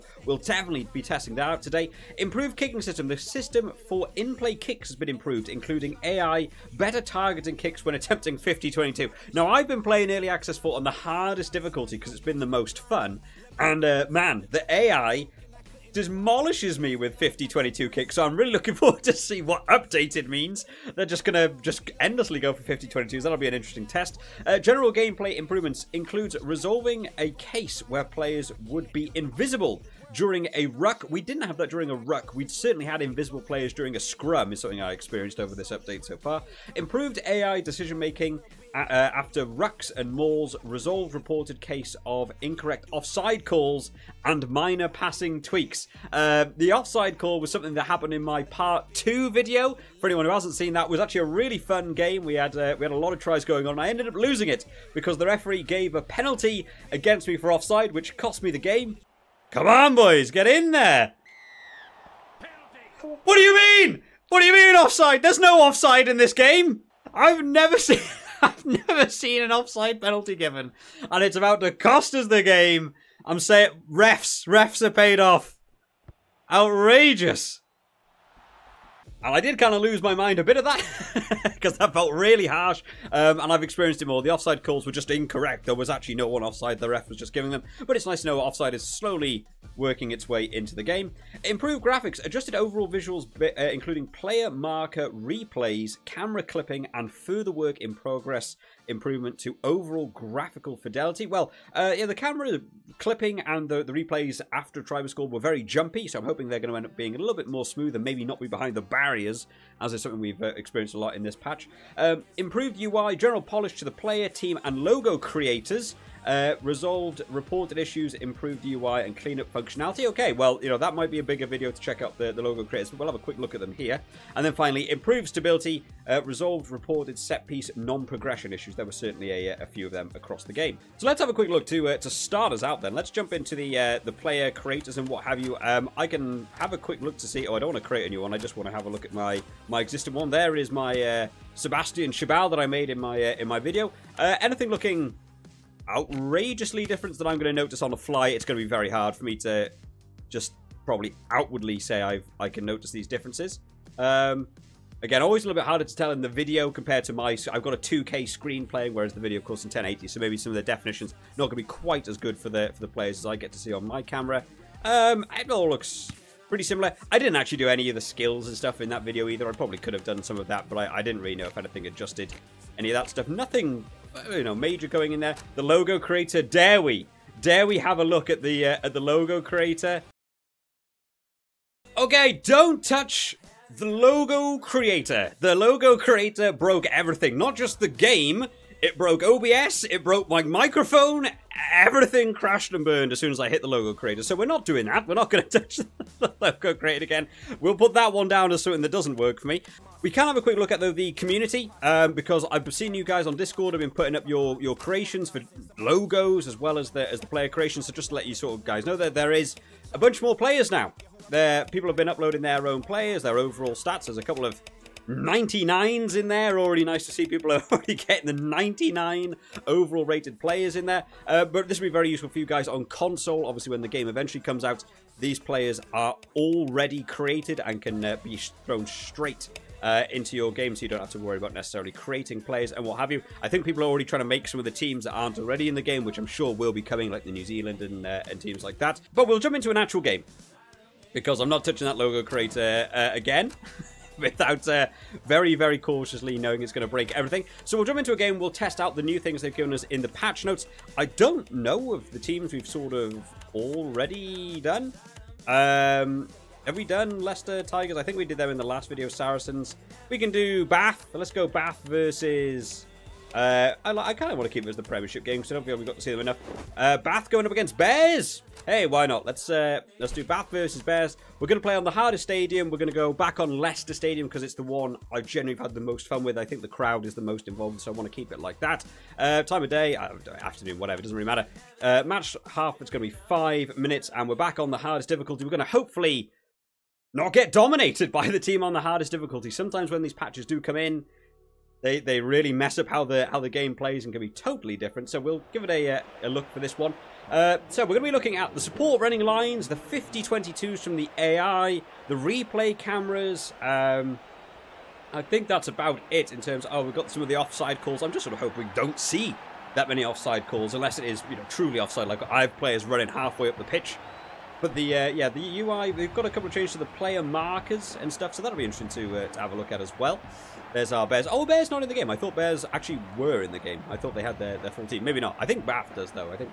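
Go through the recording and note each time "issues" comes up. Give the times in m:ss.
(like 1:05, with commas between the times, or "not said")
1:57, 2:08.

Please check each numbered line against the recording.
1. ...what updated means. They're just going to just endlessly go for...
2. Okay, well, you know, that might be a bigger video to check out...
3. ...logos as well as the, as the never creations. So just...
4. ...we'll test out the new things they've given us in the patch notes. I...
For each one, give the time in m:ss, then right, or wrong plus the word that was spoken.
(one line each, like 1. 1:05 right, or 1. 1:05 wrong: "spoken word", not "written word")
1. 0:19 right
2. 2:00 right
3. 3:25 wrong: "player", not "never"
4. 4:08 right.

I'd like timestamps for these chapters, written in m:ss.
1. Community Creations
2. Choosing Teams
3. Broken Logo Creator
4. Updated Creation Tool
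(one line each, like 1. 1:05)
1. 3:19
2. 4:03
3. 2:52
4. 2:10.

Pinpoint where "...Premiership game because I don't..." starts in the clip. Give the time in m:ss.
4:24.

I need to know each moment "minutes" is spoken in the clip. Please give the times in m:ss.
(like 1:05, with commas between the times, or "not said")
4:43.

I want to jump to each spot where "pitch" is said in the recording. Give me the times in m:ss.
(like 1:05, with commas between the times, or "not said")
5:13.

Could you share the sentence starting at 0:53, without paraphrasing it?
And I ended up losing it because the referee gave a penalty against me for offside, which cost me the game.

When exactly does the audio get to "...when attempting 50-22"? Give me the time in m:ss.
0:07.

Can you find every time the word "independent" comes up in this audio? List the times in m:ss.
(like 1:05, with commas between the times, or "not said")
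not said.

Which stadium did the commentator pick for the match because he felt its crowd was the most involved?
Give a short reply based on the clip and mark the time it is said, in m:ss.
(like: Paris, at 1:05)
Leicester Stadium, at 4:33.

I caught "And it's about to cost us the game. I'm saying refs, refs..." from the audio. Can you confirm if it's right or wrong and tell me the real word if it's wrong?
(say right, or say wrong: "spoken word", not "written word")
right.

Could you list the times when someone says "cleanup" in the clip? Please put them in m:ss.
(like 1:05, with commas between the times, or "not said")
1:59.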